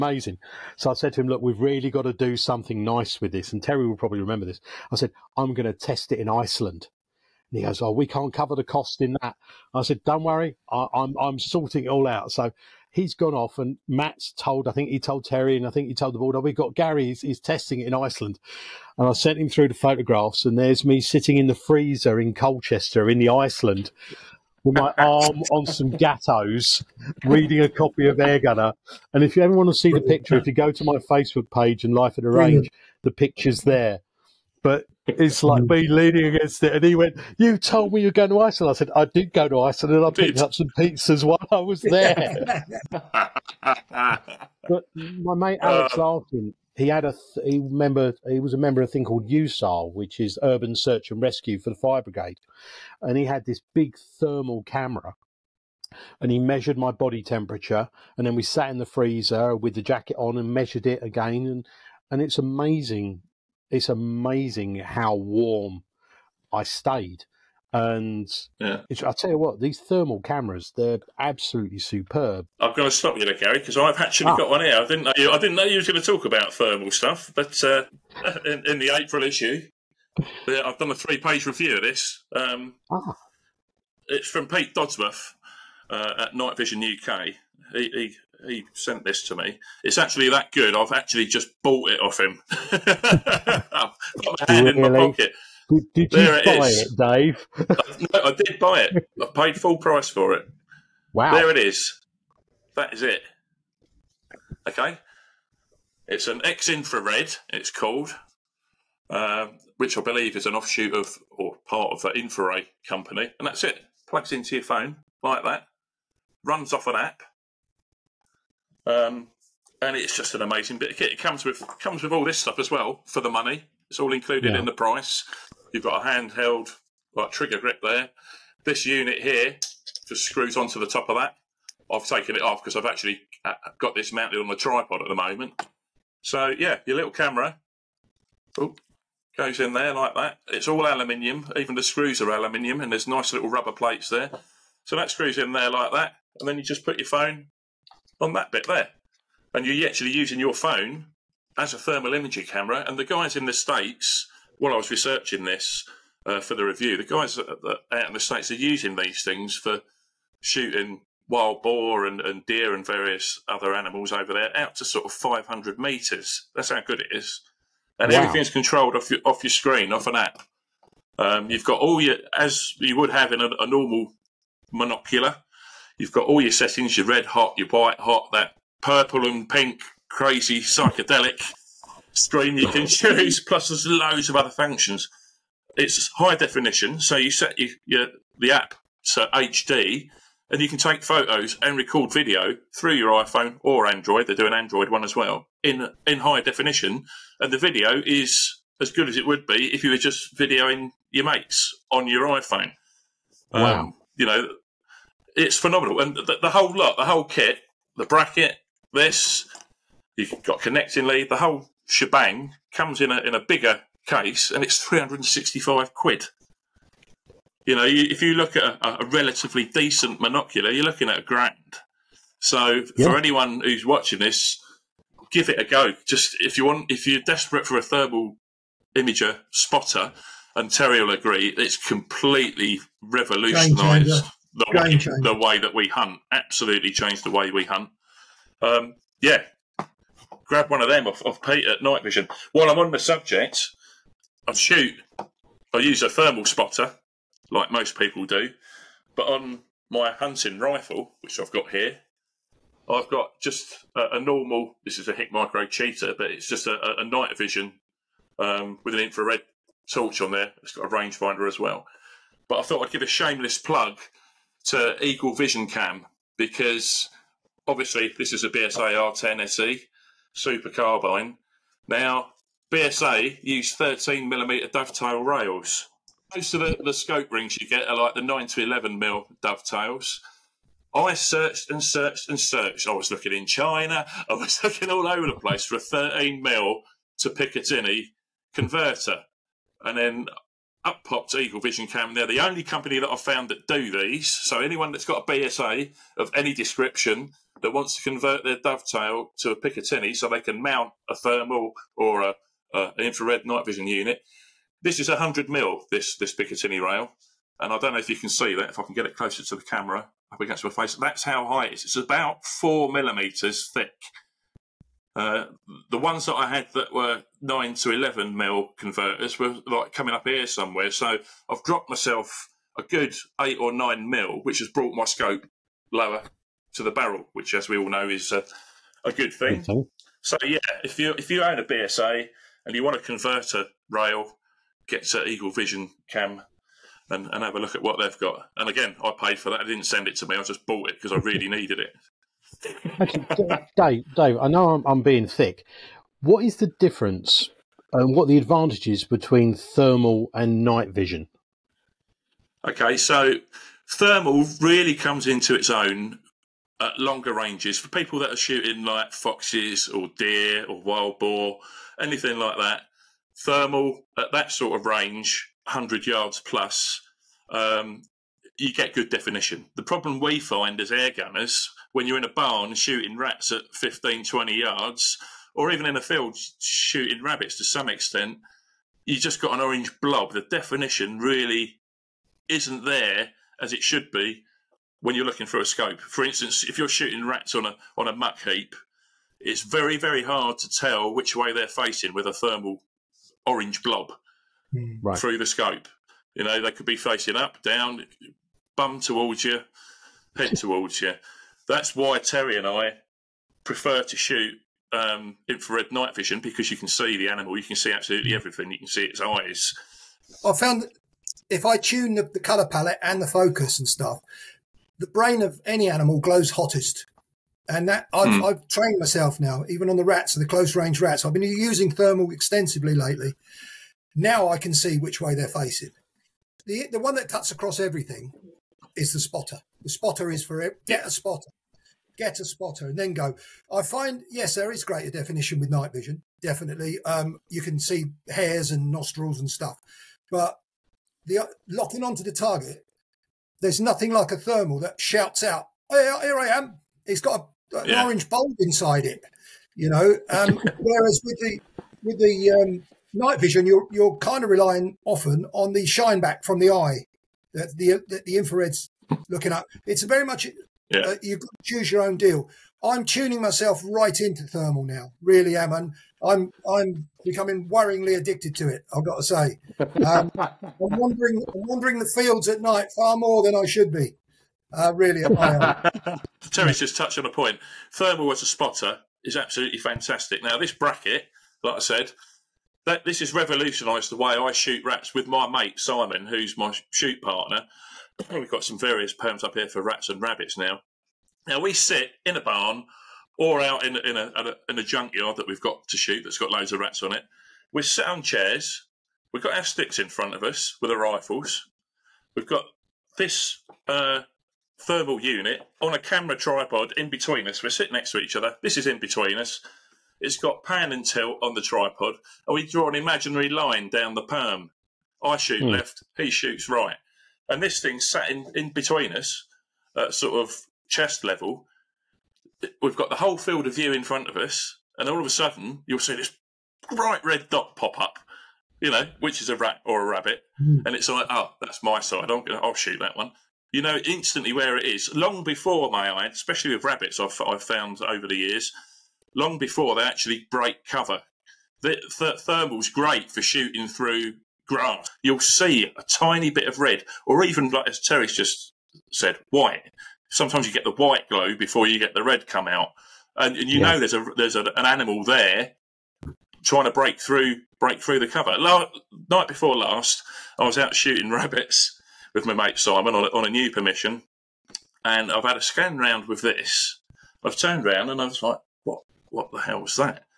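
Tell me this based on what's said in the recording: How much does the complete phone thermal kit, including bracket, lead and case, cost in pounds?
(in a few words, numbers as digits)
£365.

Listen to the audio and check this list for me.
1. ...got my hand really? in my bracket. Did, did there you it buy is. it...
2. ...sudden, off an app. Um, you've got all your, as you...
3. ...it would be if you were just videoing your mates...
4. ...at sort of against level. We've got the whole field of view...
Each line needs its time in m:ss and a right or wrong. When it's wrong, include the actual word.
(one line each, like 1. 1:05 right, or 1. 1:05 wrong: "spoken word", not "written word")
1. 1:32 wrong: "pocket", not "bracket"
2. 2:49 wrong: "screen", not "sudden"
3. 3:19 right
4. 8:39 wrong: "chest", not "against".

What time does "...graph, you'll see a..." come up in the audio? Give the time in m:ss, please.
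9:04.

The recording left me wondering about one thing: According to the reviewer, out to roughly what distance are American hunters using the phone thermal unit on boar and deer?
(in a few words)
500 meters.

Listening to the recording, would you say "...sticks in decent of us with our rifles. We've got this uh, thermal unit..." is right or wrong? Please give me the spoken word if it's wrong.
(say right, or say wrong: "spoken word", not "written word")
wrong: "front", not "decent".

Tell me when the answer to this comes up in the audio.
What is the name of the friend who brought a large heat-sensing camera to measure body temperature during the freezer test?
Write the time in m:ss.
0:45.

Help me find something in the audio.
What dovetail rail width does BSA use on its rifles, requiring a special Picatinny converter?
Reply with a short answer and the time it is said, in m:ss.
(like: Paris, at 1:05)
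13 millimeters, at 4:33.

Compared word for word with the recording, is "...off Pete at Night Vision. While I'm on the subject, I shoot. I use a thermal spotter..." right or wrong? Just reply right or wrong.
right.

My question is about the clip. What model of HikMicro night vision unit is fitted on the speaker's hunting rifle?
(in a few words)
Cheetah.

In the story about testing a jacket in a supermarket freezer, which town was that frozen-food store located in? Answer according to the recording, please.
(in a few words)
Colchester.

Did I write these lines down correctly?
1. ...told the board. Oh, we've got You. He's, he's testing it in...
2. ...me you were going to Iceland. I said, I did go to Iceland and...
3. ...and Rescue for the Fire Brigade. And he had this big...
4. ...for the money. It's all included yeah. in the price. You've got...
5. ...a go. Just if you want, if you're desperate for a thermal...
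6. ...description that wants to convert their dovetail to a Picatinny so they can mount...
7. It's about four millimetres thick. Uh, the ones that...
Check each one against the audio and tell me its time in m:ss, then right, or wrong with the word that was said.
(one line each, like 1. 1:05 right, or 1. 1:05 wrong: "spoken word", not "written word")
1. 0:15 wrong: "Gary", not "You"
2. 0:37 right
3. 0:51 right
4. 2:03 right
5. 3:45 right
6. 4:56 right
7. 5:11 right.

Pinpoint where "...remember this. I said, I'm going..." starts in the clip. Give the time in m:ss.
0:04.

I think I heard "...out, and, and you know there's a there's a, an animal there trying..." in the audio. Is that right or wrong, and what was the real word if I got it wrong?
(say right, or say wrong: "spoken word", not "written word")
right.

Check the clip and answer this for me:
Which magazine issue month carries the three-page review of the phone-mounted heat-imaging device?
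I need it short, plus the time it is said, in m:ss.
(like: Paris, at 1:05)
April, at 1:18.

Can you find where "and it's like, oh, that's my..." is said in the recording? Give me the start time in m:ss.
8:50.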